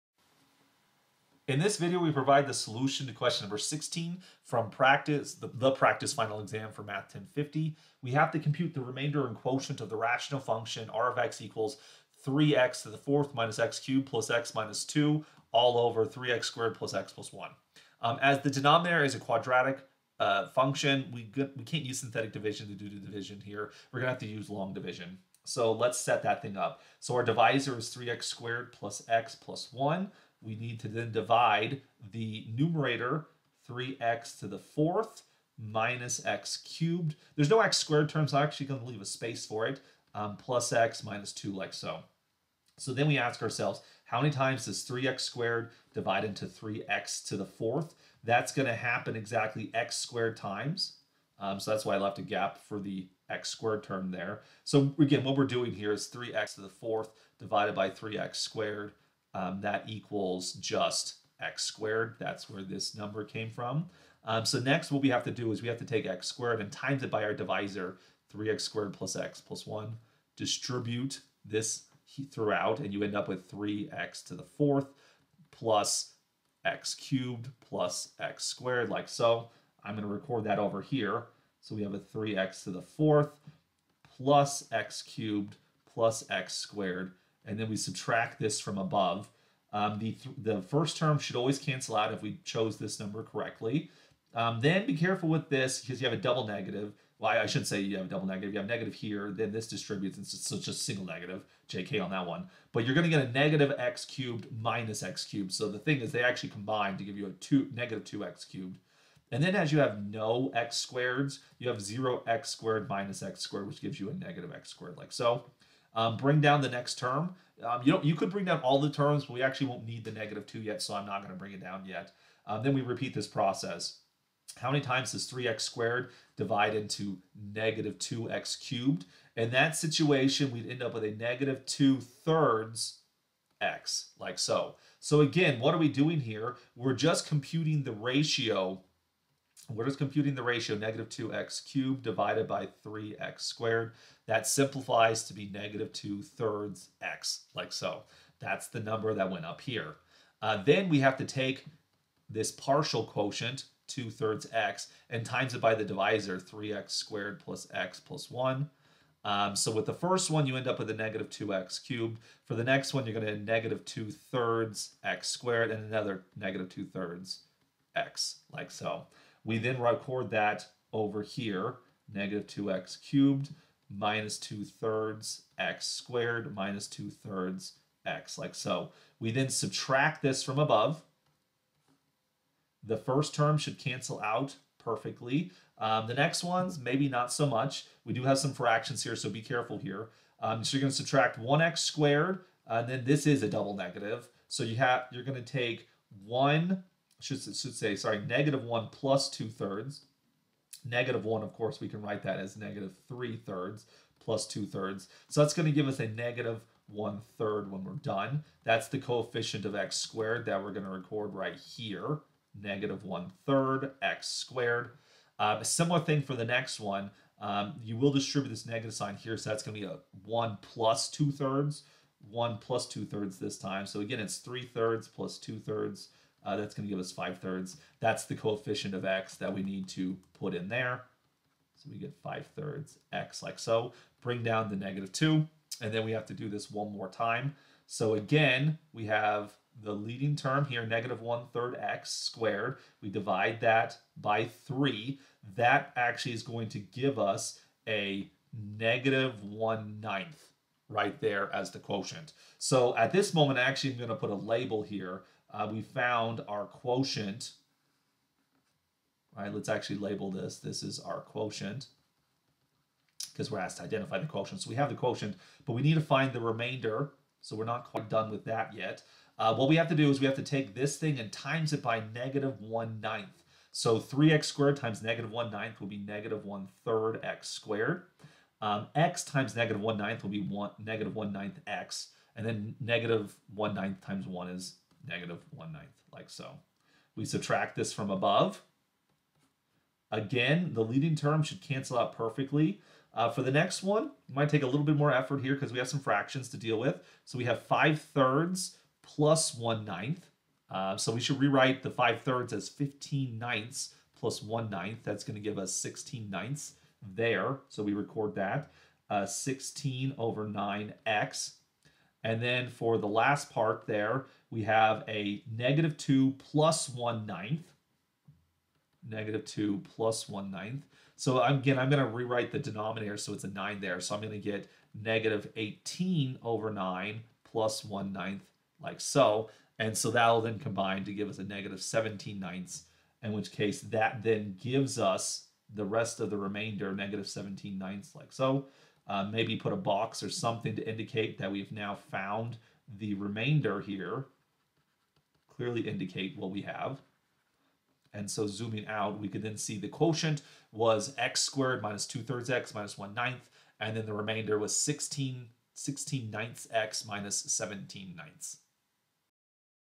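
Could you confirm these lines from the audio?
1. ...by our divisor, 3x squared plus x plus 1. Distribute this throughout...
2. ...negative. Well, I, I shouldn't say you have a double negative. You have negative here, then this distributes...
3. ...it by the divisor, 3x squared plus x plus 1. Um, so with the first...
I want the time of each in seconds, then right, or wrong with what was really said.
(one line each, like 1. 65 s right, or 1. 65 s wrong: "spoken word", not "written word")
1. 67 s right
2. 96 s right
3. 155 s right.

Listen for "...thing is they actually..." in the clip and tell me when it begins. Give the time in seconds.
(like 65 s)
105 s.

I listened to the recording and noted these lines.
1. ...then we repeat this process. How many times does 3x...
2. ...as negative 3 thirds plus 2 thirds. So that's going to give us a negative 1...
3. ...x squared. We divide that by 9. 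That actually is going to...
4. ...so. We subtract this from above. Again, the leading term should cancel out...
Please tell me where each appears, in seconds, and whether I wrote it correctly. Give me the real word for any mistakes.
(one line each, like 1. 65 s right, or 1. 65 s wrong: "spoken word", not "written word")
1. 122 s right
2. 202 s right
3. 241 s wrong: "3", not "9"
4. 286 s right.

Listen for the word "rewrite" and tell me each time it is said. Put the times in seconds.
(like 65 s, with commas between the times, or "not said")
301 s, 322 s.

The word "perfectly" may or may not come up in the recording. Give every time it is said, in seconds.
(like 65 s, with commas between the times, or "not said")
184 s, 292 s.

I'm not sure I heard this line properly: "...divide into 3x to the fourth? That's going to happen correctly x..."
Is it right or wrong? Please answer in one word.
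wrong.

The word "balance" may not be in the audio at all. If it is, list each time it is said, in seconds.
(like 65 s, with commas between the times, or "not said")
not said.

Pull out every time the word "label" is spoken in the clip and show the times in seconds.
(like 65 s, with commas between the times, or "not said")
254 s, 259 s.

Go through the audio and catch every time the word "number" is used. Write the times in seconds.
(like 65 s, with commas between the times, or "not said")
3 s, 62 s, 92 s, 148 s.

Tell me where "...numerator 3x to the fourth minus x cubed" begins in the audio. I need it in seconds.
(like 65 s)
32 s.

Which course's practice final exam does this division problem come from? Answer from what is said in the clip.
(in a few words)
Math 1050.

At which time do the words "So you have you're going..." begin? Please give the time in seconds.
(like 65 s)
194 s.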